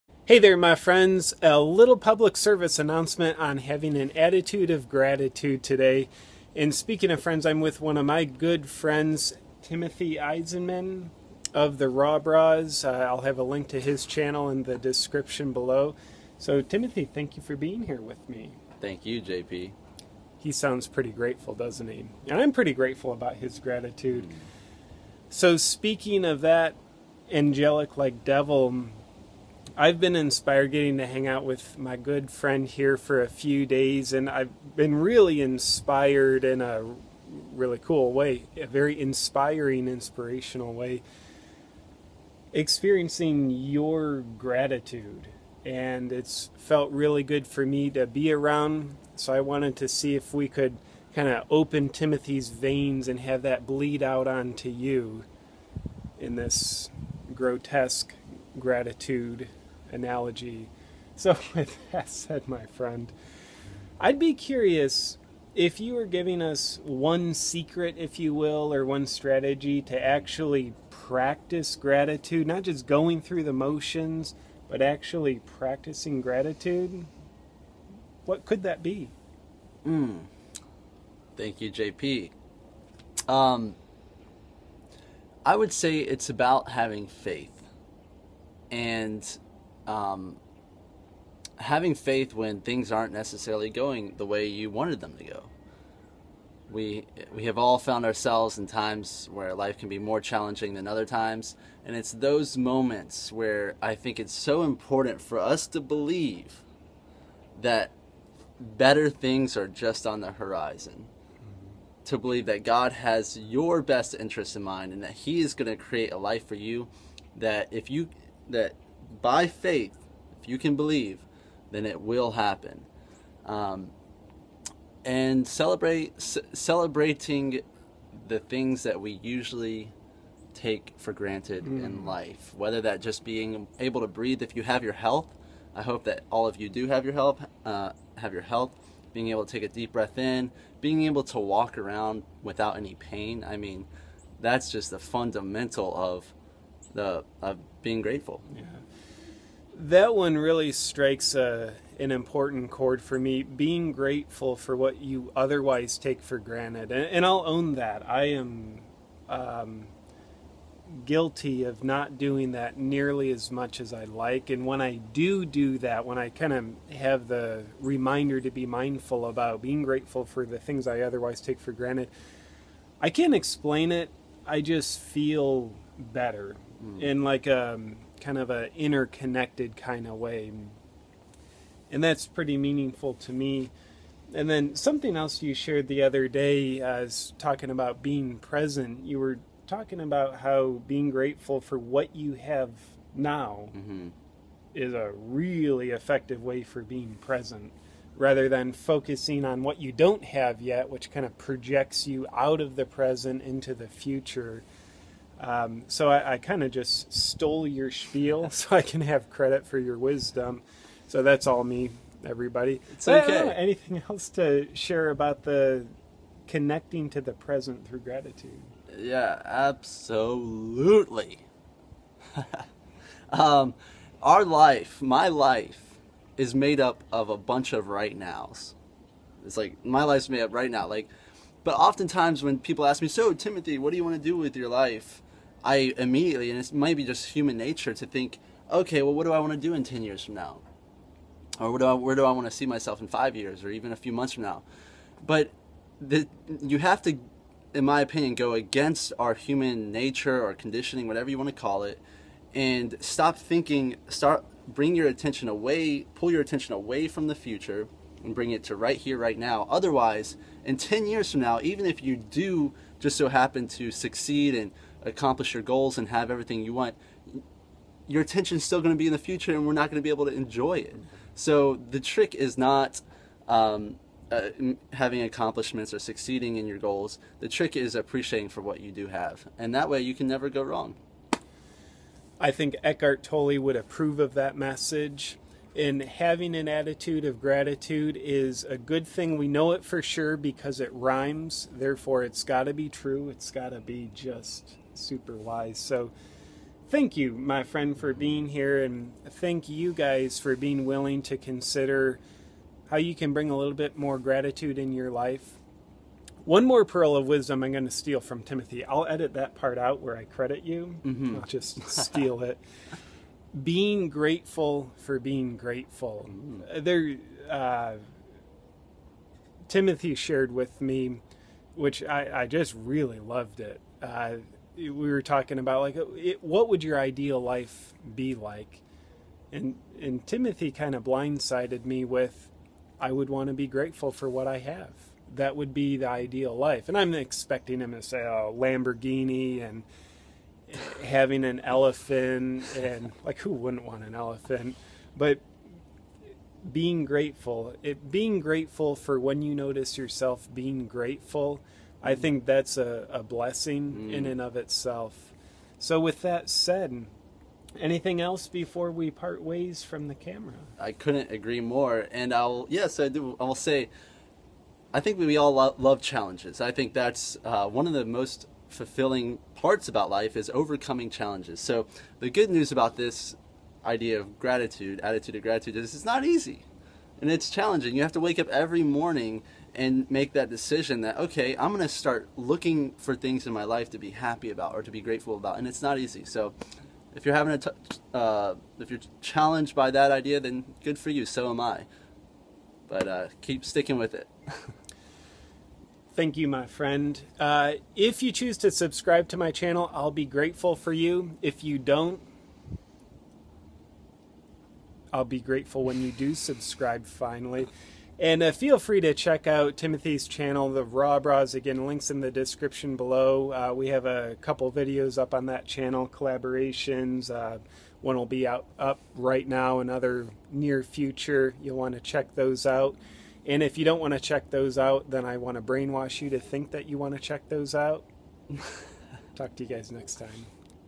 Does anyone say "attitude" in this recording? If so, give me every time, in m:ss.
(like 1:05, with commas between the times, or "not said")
0:04, 4:46, 6:15.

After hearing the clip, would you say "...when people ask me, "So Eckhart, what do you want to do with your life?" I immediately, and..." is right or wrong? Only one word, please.
wrong.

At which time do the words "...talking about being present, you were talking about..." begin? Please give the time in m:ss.
3:07.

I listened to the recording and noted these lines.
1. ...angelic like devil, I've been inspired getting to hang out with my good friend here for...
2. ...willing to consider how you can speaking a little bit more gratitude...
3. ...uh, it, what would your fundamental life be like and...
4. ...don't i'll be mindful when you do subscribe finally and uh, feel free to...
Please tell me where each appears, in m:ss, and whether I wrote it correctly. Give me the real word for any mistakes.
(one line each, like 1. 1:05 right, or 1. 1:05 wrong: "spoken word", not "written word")
1. 0:27 right
2. 5:00 wrong: "bring", not "speaking"
3. 5:25 wrong: "ideal", not "fundamental"
4. 6:41 wrong: "grateful", not "mindful".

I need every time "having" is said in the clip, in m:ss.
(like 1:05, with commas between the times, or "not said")
0:03, 1:26, 1:31, 4:34, 4:46, 5:41, 6:27.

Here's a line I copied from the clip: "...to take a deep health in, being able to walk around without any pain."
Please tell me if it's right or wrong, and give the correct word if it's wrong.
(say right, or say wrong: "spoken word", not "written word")
wrong: "breath", not "health".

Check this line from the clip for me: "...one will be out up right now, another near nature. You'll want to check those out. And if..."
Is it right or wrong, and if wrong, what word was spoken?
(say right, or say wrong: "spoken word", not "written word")
wrong: "future", not "nature".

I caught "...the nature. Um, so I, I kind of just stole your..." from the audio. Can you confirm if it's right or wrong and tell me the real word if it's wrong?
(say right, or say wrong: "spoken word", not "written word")
wrong: "future", not "nature".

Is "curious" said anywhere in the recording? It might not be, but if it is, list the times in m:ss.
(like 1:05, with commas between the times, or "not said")
1:04.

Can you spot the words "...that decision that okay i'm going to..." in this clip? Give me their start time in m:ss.
6:20.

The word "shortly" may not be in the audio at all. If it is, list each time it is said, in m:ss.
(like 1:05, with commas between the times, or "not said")
not said.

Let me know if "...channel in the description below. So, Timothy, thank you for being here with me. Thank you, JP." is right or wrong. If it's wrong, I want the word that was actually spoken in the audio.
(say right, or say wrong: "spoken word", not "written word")
right.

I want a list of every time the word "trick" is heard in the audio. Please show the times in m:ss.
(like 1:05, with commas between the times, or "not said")
4:31, 4:37.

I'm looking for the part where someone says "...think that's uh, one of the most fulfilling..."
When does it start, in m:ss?
6:06.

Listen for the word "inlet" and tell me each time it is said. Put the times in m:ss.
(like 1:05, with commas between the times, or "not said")
not said.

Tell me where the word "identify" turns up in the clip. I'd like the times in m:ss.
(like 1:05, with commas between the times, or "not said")
not said.